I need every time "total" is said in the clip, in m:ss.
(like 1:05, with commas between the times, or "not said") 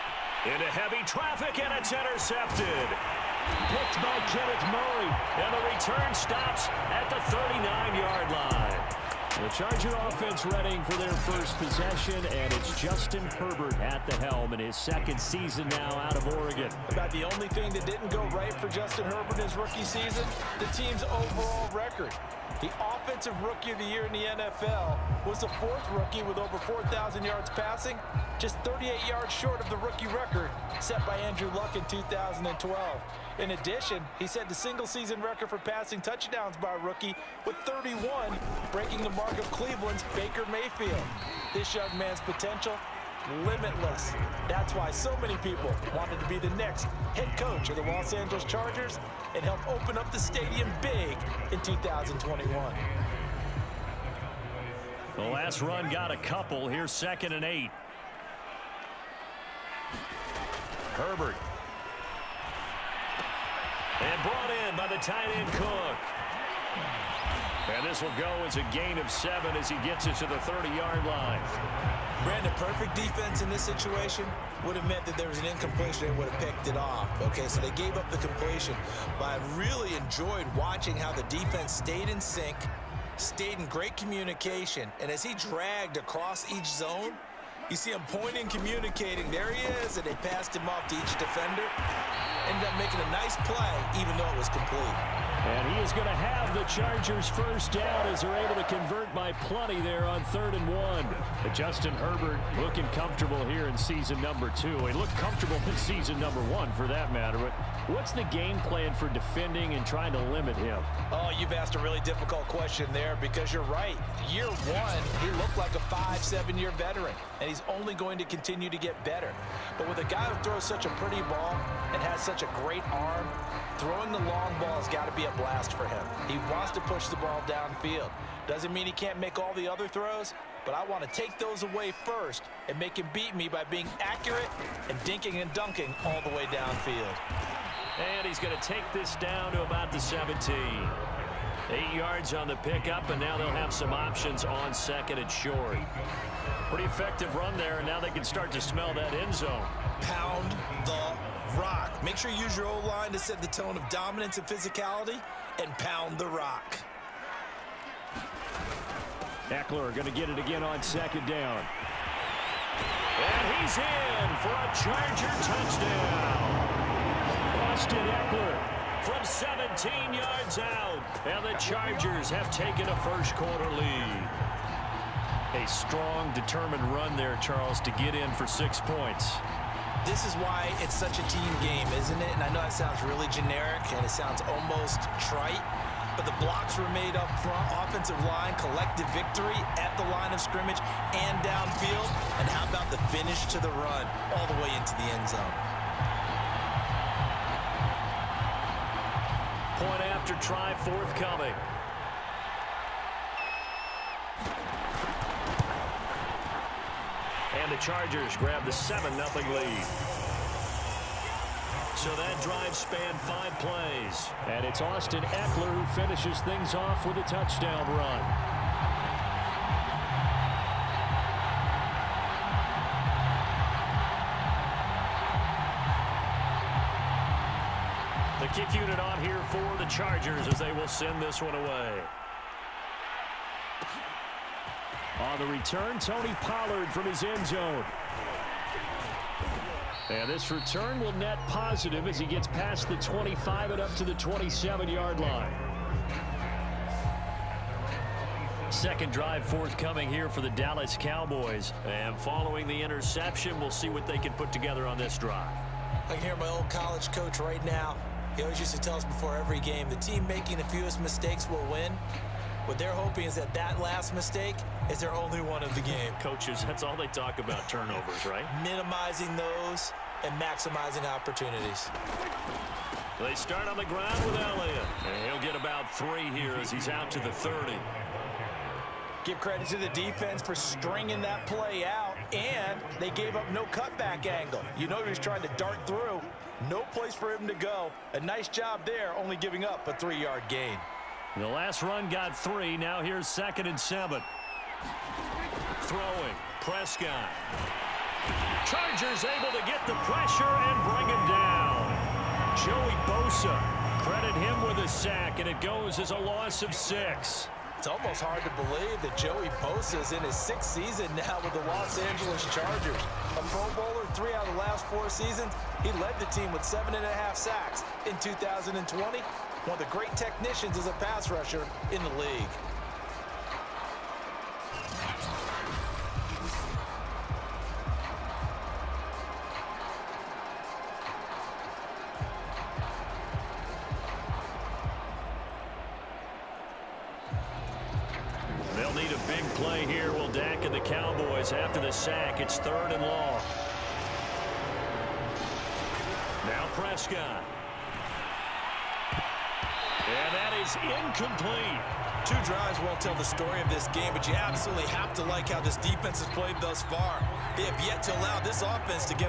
not said.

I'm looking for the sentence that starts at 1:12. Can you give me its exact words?
Brandon, perfect defense in this situation would have meant that there was an incompletion.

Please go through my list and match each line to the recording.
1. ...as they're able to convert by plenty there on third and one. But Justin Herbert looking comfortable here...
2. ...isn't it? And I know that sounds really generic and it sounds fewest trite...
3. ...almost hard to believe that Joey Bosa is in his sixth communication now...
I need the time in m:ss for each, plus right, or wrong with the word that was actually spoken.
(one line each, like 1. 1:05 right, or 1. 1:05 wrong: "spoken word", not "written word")
1. 1:38 right
2. 3:01 wrong: "almost", not "fewest"
3. 5:07 wrong: "season", not "communication".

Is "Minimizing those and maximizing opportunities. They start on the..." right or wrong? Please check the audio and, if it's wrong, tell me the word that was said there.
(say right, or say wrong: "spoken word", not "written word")
right.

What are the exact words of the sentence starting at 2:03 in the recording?
Throwing the long ball has got to be a blast for him.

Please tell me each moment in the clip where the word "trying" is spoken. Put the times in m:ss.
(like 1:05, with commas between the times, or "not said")
1:49, 4:45.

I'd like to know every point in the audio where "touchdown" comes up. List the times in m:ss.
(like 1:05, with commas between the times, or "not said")
0:36, 2:45, 3:37.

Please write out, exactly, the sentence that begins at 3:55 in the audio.
On the return, Tony Pollard from his end zone.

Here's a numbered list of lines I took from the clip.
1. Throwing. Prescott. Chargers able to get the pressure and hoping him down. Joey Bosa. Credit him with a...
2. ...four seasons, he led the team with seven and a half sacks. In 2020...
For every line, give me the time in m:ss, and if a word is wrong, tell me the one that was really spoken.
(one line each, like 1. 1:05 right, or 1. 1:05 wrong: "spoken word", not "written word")
1. 4:55 wrong: "bring", not "hoping"
2. 5:14 right.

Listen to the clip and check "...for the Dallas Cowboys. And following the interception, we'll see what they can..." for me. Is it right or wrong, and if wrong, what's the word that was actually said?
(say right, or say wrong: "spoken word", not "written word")
right.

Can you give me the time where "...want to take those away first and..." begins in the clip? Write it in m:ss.
2:10.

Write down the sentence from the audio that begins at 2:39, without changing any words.
Ekeler going to get it again on second down.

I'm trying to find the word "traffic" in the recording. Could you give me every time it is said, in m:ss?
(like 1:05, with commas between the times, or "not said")
0:01.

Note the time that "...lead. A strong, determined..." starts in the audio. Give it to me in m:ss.
2:53.